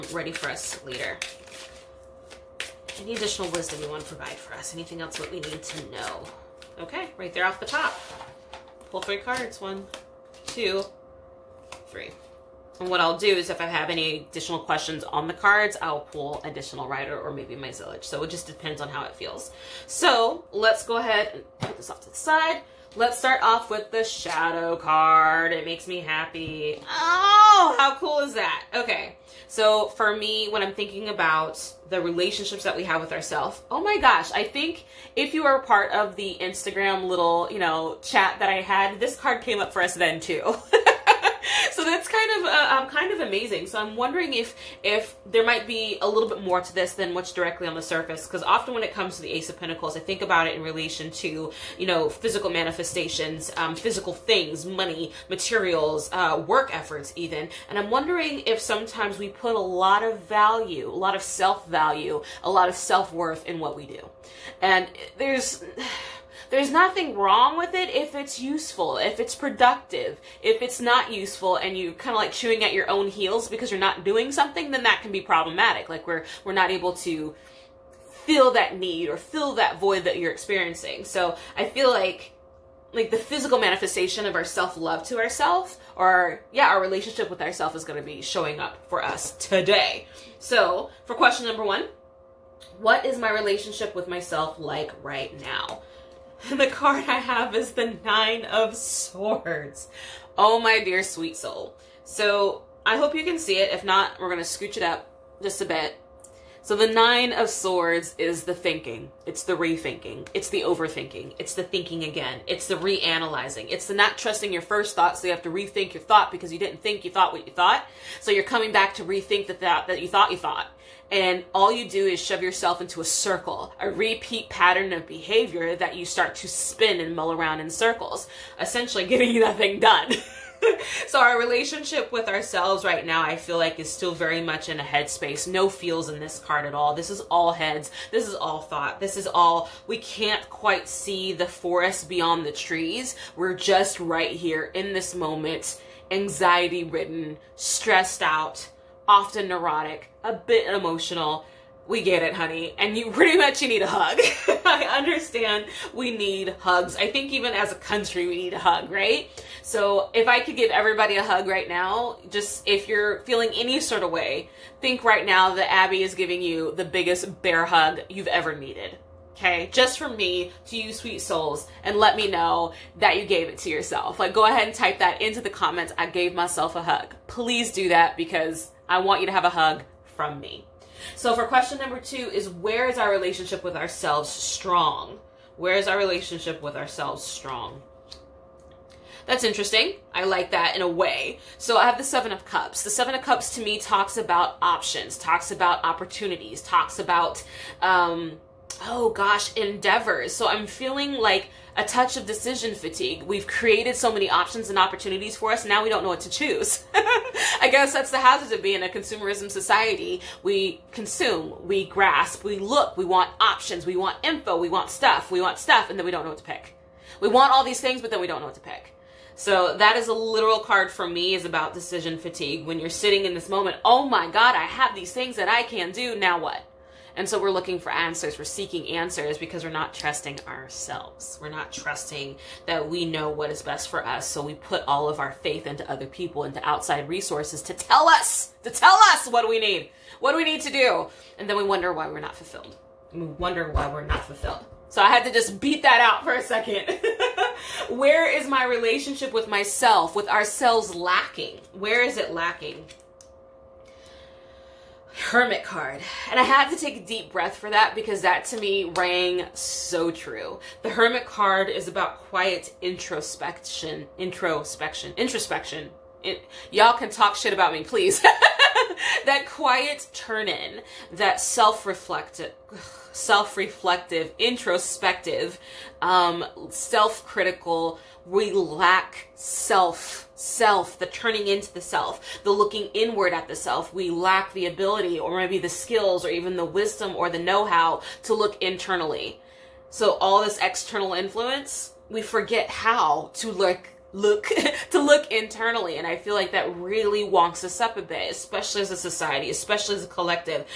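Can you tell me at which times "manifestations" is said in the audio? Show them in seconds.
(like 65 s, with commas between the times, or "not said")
52 s, 83 s.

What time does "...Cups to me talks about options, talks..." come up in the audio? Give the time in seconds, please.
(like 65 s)
193 s.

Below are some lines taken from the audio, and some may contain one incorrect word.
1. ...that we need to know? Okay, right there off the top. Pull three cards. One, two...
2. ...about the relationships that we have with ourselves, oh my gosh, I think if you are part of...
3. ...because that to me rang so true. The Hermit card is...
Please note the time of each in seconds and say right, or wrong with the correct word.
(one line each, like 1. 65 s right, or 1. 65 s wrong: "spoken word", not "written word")
1. 5 s right
2. 31 s right
3. 257 s right.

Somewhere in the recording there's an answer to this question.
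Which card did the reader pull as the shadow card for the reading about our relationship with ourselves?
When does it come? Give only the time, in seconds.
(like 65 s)
49 s.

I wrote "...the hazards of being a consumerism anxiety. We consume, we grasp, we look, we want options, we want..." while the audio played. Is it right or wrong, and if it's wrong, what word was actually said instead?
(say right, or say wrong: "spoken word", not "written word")
wrong: "society", not "anxiety".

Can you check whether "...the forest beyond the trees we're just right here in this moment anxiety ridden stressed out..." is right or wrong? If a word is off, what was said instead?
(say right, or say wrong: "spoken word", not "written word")
right.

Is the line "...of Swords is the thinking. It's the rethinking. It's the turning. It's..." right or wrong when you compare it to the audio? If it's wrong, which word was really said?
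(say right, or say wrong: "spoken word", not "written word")
wrong: "overthinking", not "turning".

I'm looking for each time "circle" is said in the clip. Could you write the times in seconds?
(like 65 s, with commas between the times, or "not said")
123 s, 127 s.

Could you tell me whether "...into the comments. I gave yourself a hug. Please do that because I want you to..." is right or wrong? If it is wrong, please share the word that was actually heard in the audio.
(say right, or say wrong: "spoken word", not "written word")
wrong: "myself", not "yourself".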